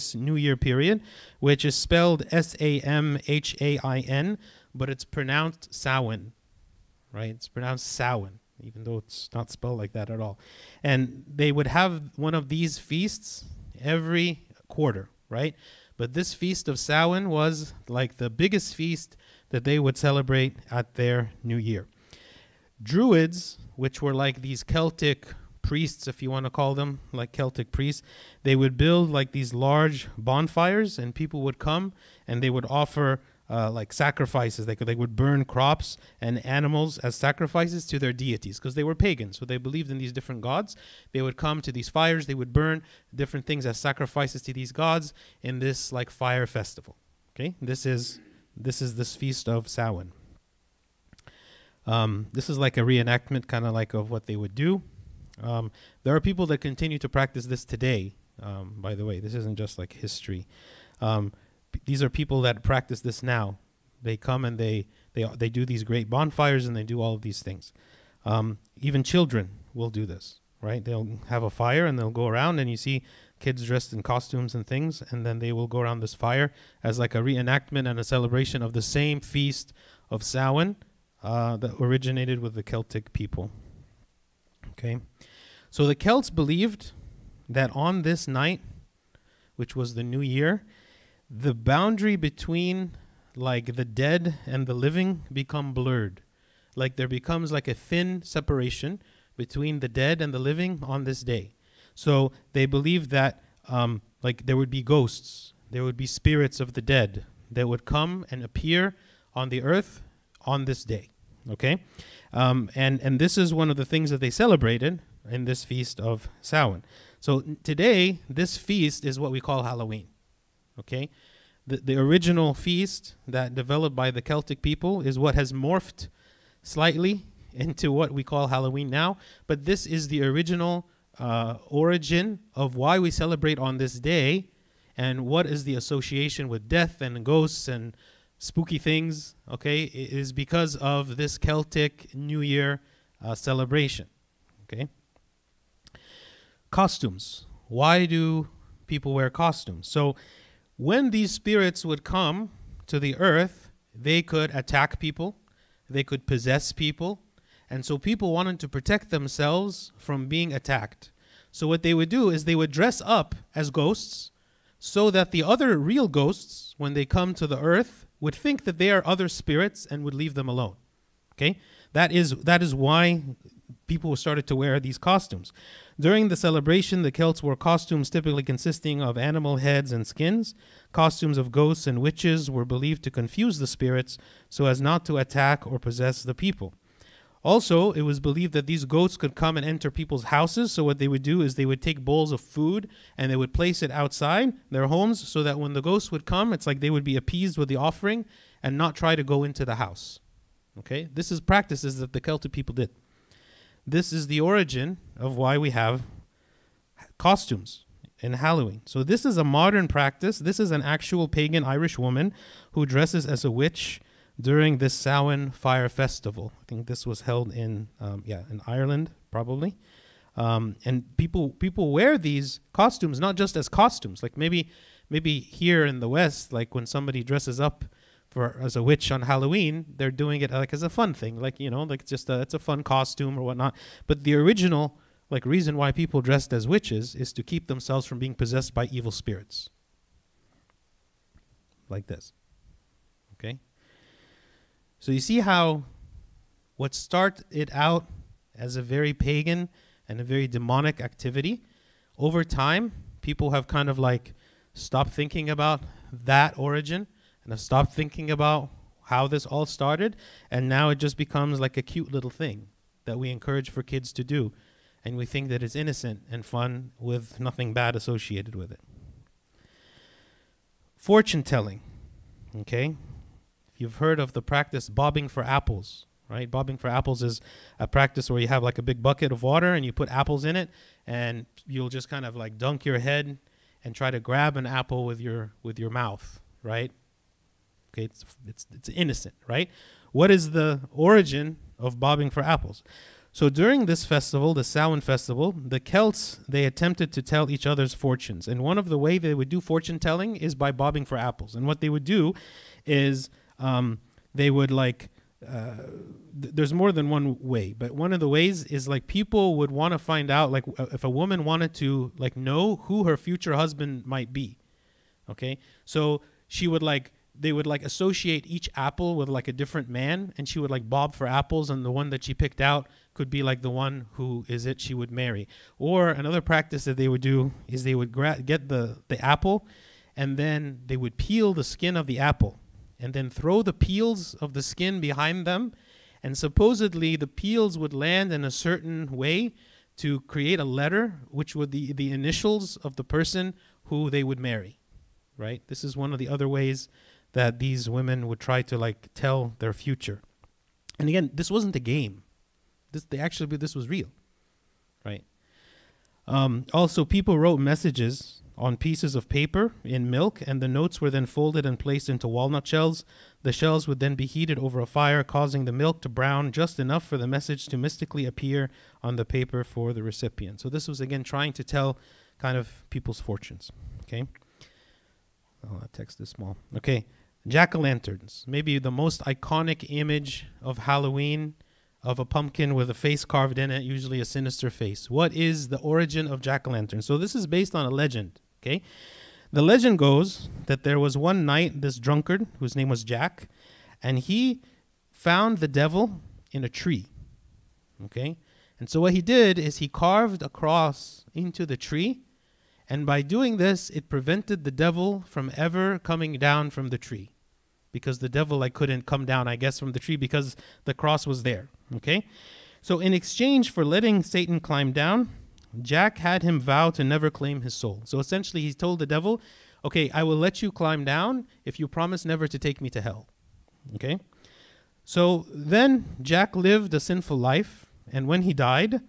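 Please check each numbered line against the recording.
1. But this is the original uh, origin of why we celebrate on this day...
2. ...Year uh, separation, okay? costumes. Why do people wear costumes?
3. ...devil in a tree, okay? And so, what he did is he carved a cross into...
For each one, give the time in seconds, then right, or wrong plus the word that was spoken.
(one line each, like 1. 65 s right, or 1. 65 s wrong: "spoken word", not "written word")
1. 129 s right
2. 142 s wrong: "celebration", not "separation"
3. 395 s right.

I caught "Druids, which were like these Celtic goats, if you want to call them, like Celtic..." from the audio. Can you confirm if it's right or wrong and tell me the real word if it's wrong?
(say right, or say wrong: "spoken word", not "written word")
wrong: "priests", not "goats".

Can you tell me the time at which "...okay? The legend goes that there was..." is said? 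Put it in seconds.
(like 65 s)
388 s.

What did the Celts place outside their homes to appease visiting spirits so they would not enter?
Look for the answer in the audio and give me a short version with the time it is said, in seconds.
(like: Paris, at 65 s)
Bowls of food, at 192 s.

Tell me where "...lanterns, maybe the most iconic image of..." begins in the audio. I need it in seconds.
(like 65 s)
377 s.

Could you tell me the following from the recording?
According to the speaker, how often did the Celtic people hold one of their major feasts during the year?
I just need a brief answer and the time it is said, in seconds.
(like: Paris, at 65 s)
Every quarter, at 13 s.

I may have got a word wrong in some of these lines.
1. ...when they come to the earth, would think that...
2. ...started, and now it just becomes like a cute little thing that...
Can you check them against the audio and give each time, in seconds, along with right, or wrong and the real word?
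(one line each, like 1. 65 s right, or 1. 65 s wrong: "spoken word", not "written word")
1. 166 s right
2. 259 s right.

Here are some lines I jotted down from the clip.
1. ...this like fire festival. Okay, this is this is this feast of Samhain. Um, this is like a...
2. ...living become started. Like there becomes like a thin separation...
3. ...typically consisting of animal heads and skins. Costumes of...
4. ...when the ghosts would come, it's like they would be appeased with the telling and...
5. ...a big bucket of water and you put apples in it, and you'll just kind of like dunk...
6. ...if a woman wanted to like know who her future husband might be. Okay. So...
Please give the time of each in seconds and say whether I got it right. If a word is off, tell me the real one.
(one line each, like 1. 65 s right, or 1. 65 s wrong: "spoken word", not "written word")
1. 45 s right
2. 94 s wrong: "blurred", not "started"
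3. 178 s right
4. 195 s wrong: "offering", not "telling"
5. 278 s right
6. 310 s right.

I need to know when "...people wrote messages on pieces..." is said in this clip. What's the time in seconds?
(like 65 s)
357 s.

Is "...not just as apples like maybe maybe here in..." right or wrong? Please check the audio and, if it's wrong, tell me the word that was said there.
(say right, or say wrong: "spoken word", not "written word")
wrong: "costumes", not "apples".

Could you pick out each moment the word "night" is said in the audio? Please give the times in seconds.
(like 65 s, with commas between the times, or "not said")
88 s, 391 s.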